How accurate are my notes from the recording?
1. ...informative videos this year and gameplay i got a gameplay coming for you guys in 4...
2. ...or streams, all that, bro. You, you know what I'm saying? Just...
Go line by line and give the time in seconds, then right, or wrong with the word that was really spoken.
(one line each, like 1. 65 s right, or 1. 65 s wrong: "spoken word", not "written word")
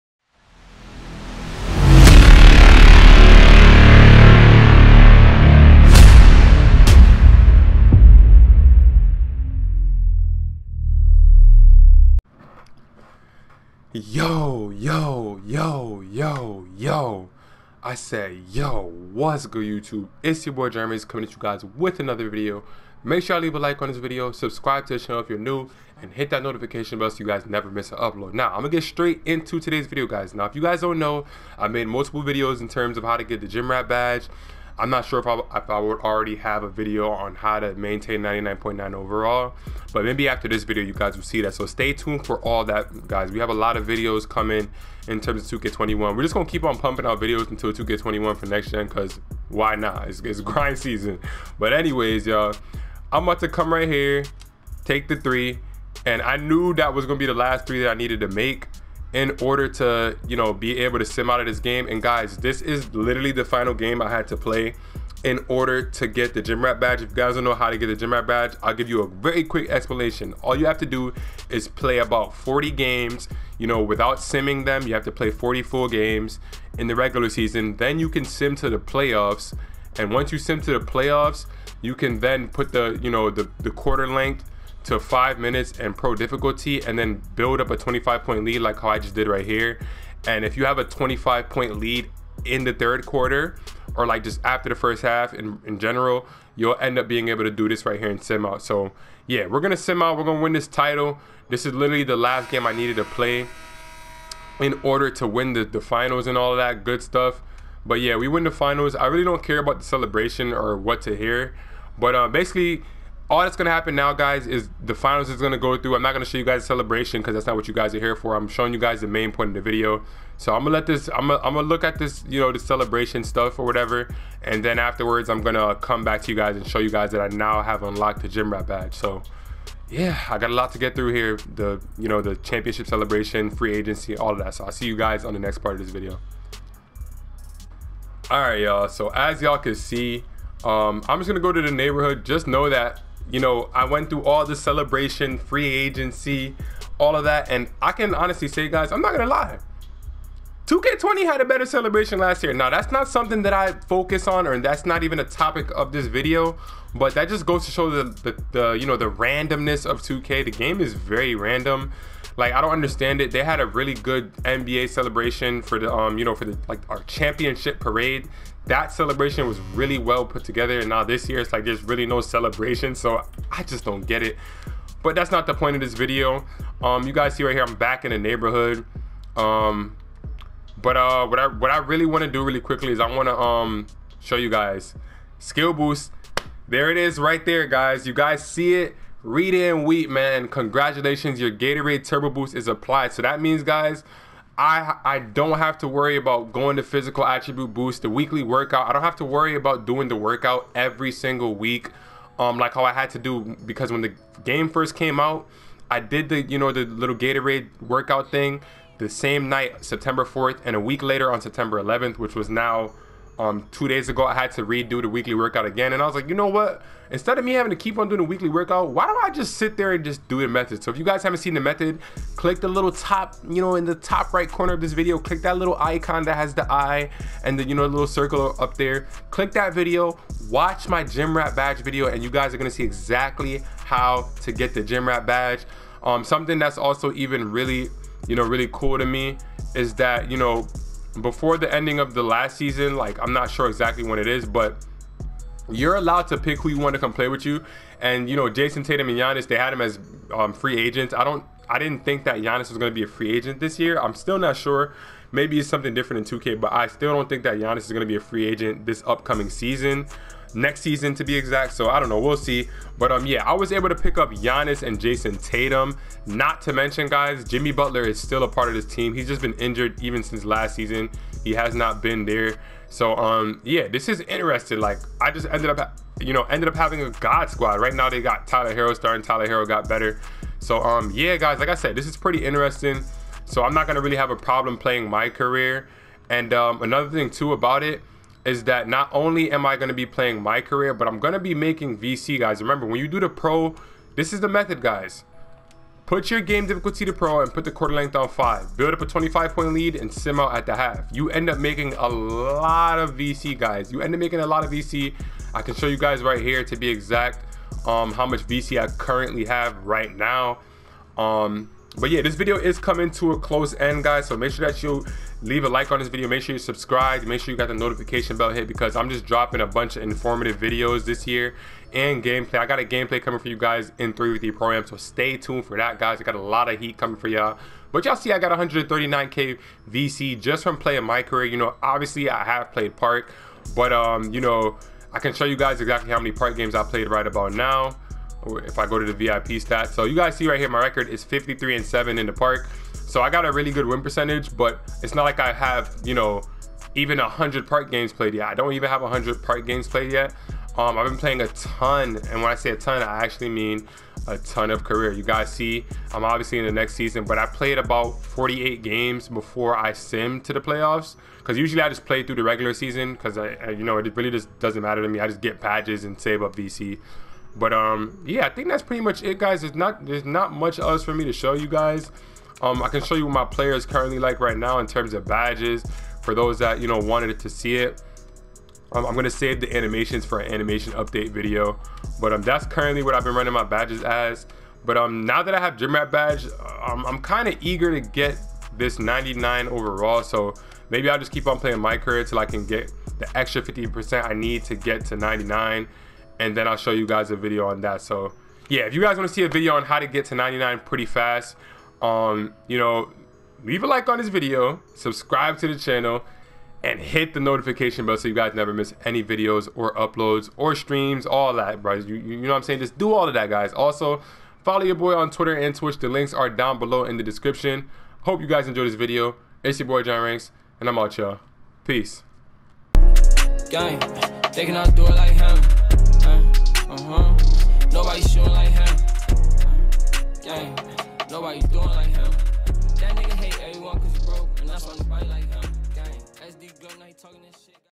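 1. 320 s wrong: "3", not "4"
2. 410 s right.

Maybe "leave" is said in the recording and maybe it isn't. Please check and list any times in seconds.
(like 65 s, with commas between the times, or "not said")
23 s, 315 s, 403 s.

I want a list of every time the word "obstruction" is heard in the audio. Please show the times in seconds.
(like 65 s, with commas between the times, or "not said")
not said.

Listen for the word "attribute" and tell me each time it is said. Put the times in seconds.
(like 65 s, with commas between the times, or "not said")
197 s.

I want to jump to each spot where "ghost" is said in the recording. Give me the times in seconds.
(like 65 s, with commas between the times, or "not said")
not said.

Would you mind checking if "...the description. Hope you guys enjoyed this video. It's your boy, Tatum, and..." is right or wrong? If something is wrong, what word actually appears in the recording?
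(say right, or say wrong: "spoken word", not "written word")
wrong: "JrRanks", not "Tatum".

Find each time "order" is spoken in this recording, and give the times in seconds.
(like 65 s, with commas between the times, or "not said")
59 s, 65 s, 104 s.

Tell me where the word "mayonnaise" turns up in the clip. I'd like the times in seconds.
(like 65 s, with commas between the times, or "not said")
not said.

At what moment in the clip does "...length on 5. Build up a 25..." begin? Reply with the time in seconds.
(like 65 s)
297 s.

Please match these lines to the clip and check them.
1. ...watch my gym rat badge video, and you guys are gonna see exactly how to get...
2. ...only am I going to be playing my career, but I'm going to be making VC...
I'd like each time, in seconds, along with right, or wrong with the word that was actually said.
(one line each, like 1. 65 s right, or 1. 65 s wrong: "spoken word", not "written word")
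1. 230 s right
2. 289 s right.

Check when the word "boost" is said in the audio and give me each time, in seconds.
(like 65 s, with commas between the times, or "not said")
185 s, 192 s, 197 s.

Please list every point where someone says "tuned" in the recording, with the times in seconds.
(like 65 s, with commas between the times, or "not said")
41 s, 325 s.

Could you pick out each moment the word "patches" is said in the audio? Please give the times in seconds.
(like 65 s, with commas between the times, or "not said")
365 s.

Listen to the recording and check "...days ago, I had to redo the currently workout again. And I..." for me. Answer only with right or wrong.
wrong.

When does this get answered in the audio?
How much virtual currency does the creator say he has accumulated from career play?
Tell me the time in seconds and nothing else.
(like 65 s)
328 s.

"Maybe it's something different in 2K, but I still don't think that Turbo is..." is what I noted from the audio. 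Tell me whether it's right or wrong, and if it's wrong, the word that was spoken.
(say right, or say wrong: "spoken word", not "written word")
wrong: "Giannis", not "Turbo".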